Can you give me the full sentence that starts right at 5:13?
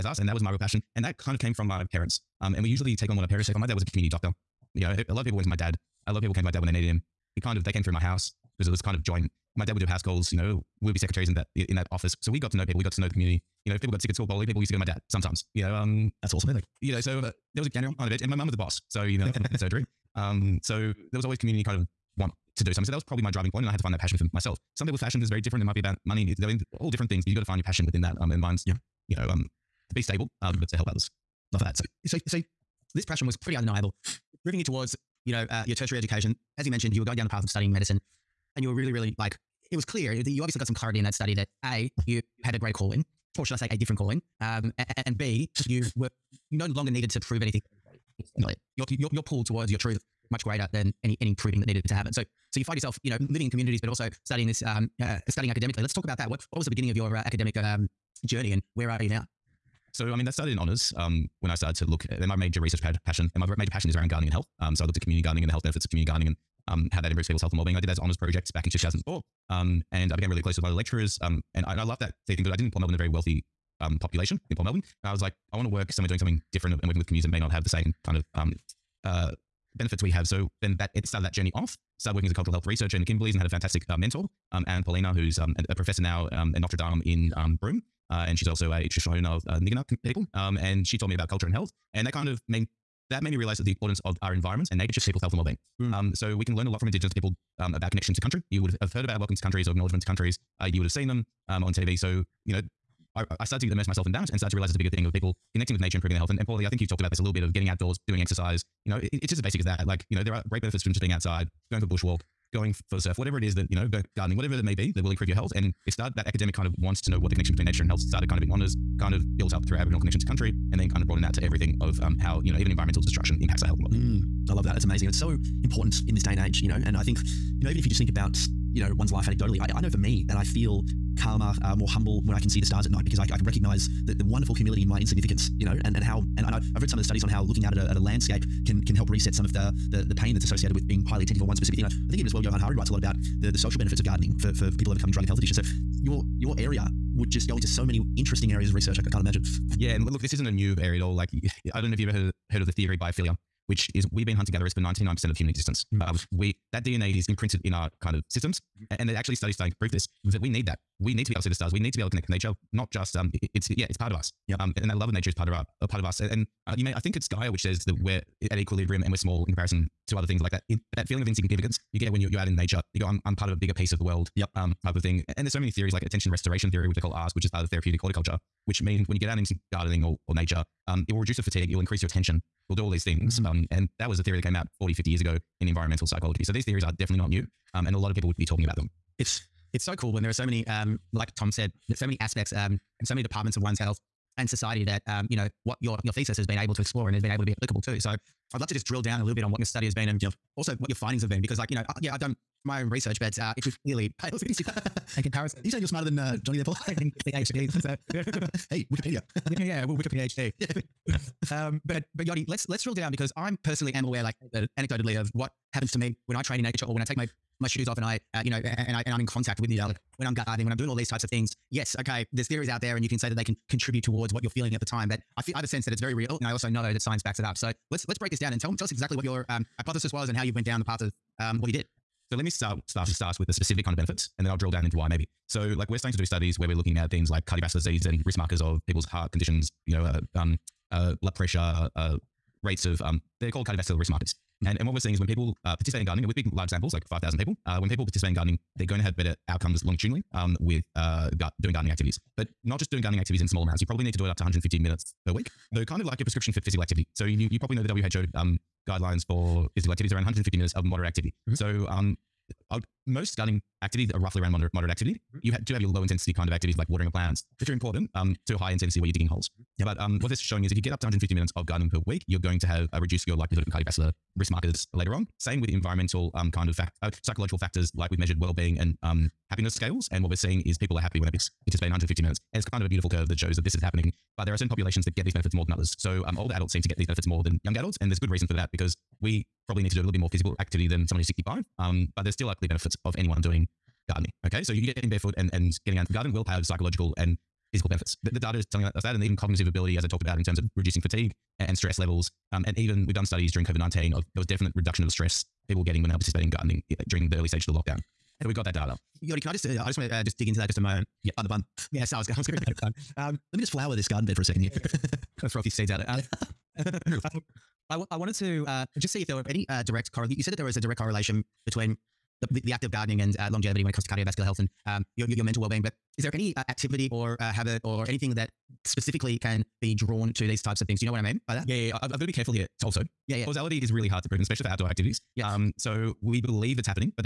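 um, Let me just flower this garden bed for a second here.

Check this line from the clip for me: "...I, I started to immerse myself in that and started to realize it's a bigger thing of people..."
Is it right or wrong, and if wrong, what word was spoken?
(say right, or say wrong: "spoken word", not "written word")
right.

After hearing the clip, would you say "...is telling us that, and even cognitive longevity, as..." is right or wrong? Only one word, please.
wrong.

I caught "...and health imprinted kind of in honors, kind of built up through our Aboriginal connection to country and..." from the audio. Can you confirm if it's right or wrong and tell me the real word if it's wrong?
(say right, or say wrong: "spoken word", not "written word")
wrong: "started", not "imprinted".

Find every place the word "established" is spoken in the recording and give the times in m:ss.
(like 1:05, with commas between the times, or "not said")
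not said.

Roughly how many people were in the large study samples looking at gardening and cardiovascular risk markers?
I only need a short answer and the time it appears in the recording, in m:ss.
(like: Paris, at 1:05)
5,000, at 4:07.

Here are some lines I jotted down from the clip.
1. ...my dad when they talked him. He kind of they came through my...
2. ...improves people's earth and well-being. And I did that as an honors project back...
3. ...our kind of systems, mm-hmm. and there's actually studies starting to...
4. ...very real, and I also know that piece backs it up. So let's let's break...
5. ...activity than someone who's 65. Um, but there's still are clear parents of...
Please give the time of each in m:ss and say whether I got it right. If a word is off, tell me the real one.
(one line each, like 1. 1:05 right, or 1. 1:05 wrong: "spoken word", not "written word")
1. 0:06 wrong: "needed", not "talked"
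2. 1:07 wrong: "health", not "earth"
3. 2:37 right
4. 3:45 wrong: "science", not "piece"
5. 4:50 wrong: "benefits", not "parents".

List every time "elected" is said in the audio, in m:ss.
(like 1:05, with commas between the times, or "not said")
not said.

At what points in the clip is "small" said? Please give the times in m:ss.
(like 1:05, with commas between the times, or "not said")
2:49, 4:13.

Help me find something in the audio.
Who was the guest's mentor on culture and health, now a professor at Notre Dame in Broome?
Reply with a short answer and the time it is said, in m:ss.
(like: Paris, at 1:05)
Anne Poelina, at 1:24.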